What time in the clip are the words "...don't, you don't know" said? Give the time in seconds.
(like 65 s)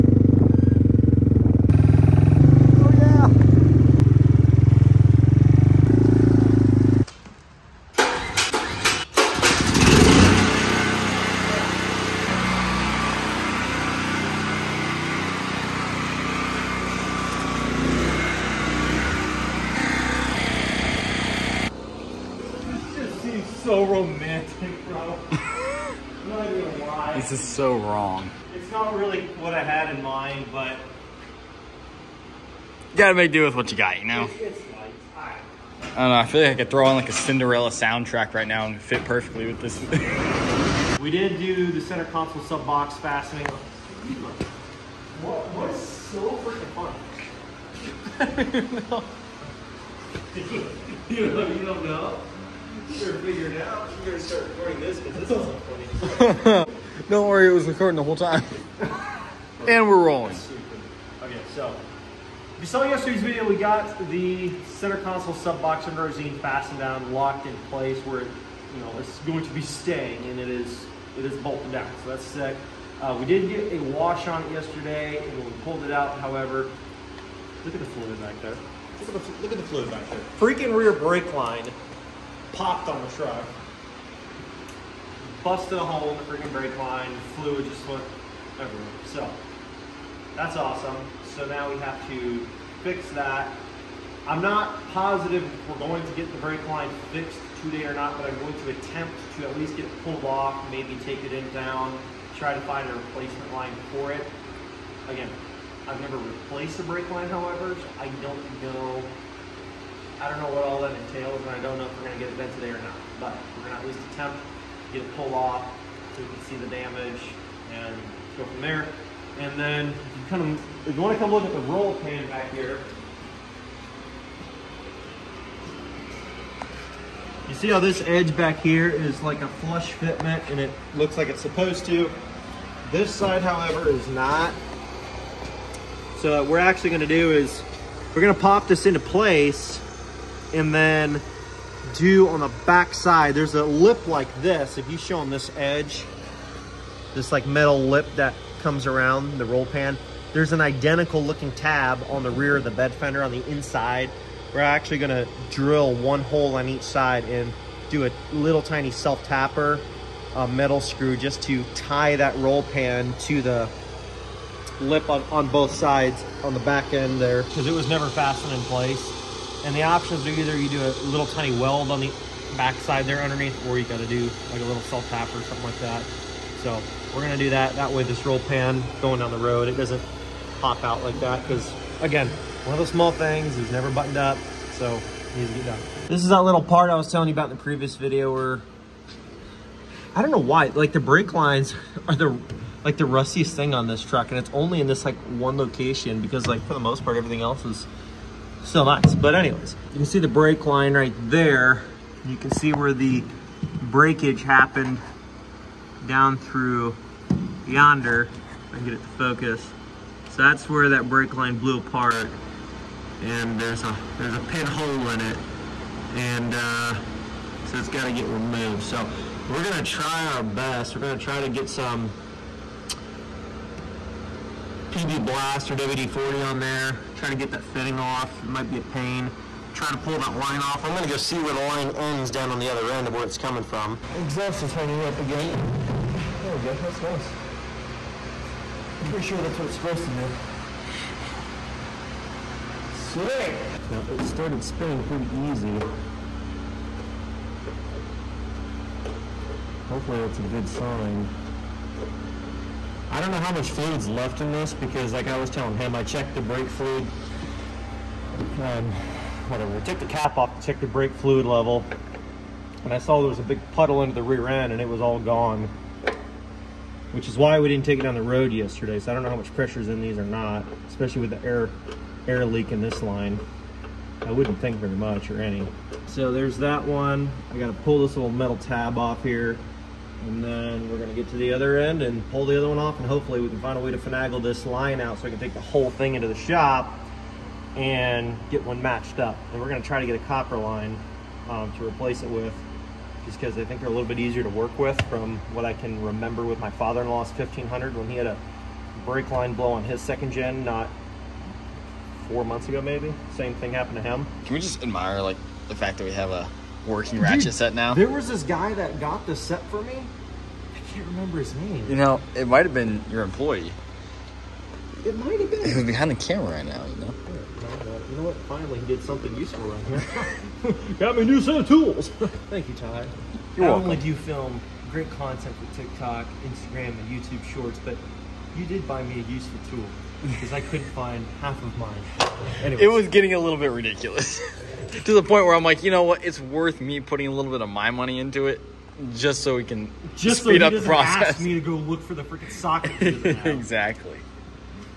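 51 s.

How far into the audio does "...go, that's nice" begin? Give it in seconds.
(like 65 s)
236 s.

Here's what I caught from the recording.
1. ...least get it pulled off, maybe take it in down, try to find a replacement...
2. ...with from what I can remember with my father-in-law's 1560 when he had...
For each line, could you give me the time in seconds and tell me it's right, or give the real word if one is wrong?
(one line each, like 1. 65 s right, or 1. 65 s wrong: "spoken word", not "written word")
1. 99 s right
2. 294 s wrong: "1500", not "1560".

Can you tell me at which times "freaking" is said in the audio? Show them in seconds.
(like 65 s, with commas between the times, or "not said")
46 s, 80 s, 86 s, 342 s.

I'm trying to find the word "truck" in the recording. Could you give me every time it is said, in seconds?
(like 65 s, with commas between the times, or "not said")
83 s, 194 s.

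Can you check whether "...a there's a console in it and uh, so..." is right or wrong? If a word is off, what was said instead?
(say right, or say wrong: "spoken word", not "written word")
wrong: "pinhole", not "console".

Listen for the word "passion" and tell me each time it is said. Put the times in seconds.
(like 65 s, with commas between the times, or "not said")
not said.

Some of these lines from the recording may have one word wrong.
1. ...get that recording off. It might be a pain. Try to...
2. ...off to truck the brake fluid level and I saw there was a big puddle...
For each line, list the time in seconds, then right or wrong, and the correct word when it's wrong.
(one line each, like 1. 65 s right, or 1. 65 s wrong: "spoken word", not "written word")
1. 227 s wrong: "fitting", not "recording"
2. 260 s wrong: "check", not "truck".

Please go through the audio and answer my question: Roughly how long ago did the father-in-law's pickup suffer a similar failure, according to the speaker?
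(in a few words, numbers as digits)
4 months.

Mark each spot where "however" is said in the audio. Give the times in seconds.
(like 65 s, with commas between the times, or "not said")
76 s, 107 s, 133 s.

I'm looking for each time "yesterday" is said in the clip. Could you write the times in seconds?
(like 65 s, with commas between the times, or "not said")
62 s, 74 s, 268 s.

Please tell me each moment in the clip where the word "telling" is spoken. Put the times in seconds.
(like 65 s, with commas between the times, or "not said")
187 s, 255 s.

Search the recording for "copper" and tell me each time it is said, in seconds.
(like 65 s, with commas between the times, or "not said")
290 s.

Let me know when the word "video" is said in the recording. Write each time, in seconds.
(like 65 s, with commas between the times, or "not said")
63 s, 187 s.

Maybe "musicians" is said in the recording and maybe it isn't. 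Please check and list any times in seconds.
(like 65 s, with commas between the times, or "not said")
not said.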